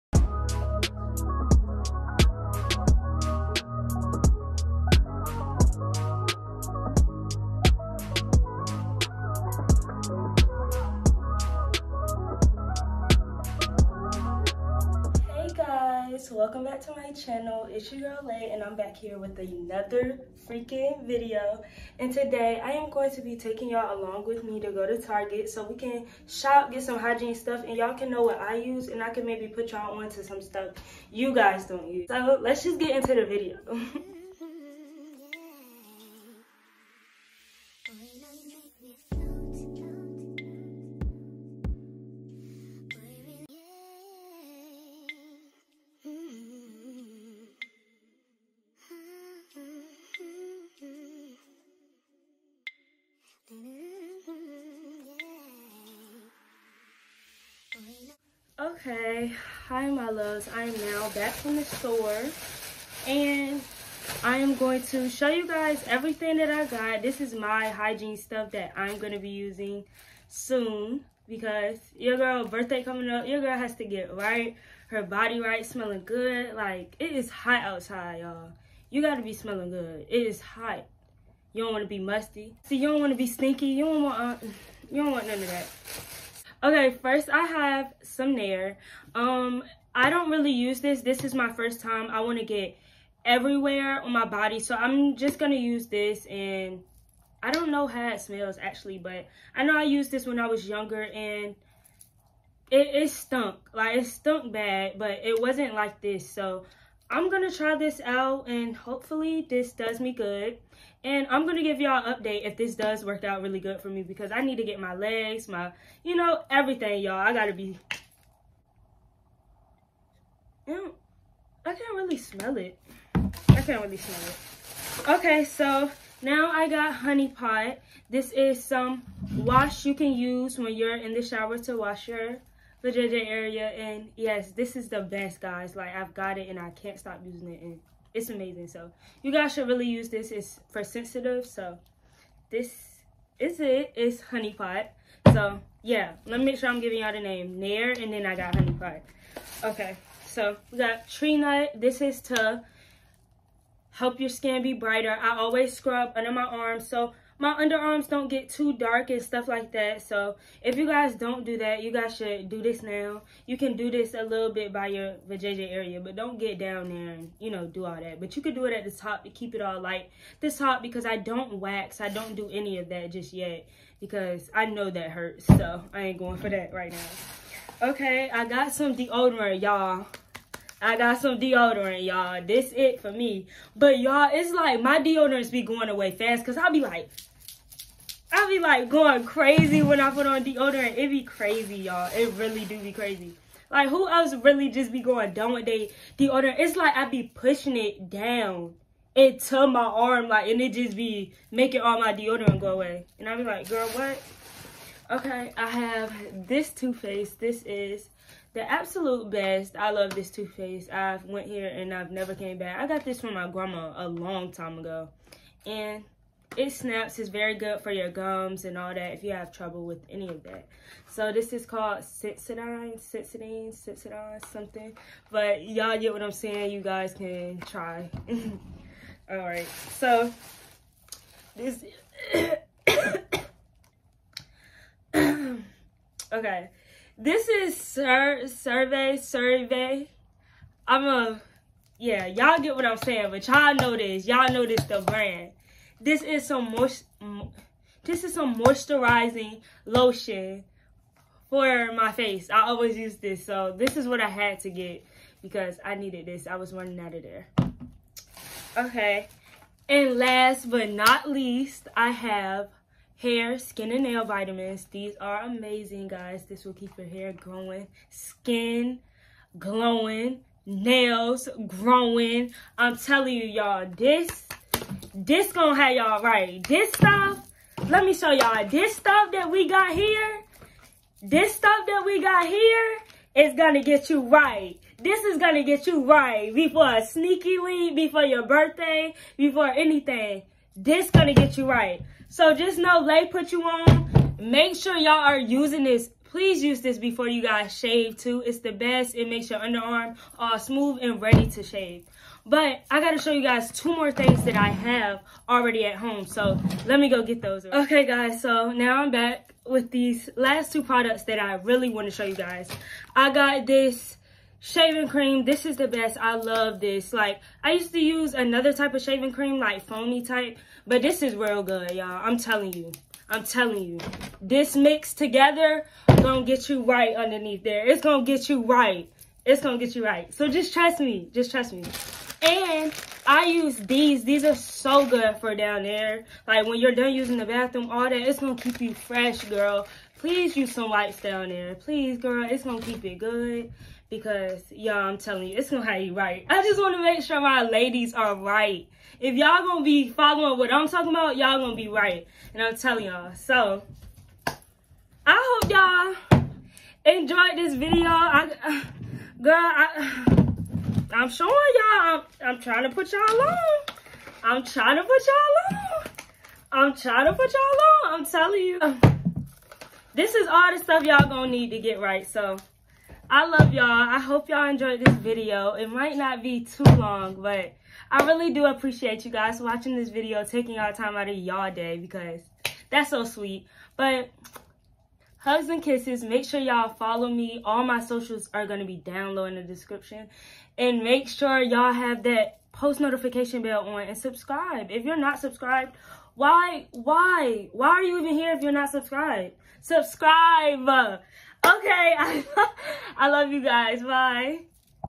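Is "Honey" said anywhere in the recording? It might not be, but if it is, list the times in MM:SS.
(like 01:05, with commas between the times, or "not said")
02:06, 02:24, 02:28.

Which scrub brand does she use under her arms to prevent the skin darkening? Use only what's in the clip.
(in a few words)
Tree Hut.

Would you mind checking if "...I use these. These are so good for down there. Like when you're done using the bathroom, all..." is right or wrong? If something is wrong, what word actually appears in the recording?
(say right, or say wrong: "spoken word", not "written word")
right.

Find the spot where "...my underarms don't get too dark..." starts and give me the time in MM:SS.
02:37.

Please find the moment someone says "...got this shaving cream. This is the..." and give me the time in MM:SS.
05:13.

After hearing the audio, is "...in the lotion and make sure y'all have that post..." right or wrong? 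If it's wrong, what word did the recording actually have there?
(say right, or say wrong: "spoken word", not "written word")
wrong: "description", not "lotion".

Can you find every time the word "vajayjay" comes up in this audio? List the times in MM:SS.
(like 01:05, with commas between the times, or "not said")
02:45.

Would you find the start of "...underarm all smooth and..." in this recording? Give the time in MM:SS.
04:59.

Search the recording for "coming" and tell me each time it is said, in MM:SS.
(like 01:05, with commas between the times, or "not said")
01:12.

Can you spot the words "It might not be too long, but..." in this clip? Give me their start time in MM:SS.
06:15.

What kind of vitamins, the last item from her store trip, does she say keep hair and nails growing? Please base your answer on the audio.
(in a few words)
hair, skin, and nail.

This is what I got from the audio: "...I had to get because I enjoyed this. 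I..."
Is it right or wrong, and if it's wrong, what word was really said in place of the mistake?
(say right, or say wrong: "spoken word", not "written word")
wrong: "needed", not "enjoyed".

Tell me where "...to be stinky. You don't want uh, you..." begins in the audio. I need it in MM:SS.
01:23.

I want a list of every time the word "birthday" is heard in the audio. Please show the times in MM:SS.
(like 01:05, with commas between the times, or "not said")
01:12, 04:48.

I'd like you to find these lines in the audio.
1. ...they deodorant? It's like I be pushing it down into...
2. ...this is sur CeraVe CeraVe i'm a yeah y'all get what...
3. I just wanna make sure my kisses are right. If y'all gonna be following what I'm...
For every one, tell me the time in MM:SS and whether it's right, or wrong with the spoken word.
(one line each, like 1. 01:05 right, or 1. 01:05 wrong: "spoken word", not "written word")
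1. 03:15 right
2. 03:57 right
3. 05:46 wrong: "ladies", not "kisses".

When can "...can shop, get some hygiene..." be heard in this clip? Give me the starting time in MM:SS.
00:25.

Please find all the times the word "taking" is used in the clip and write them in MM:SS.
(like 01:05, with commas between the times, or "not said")
00:23, 06:20.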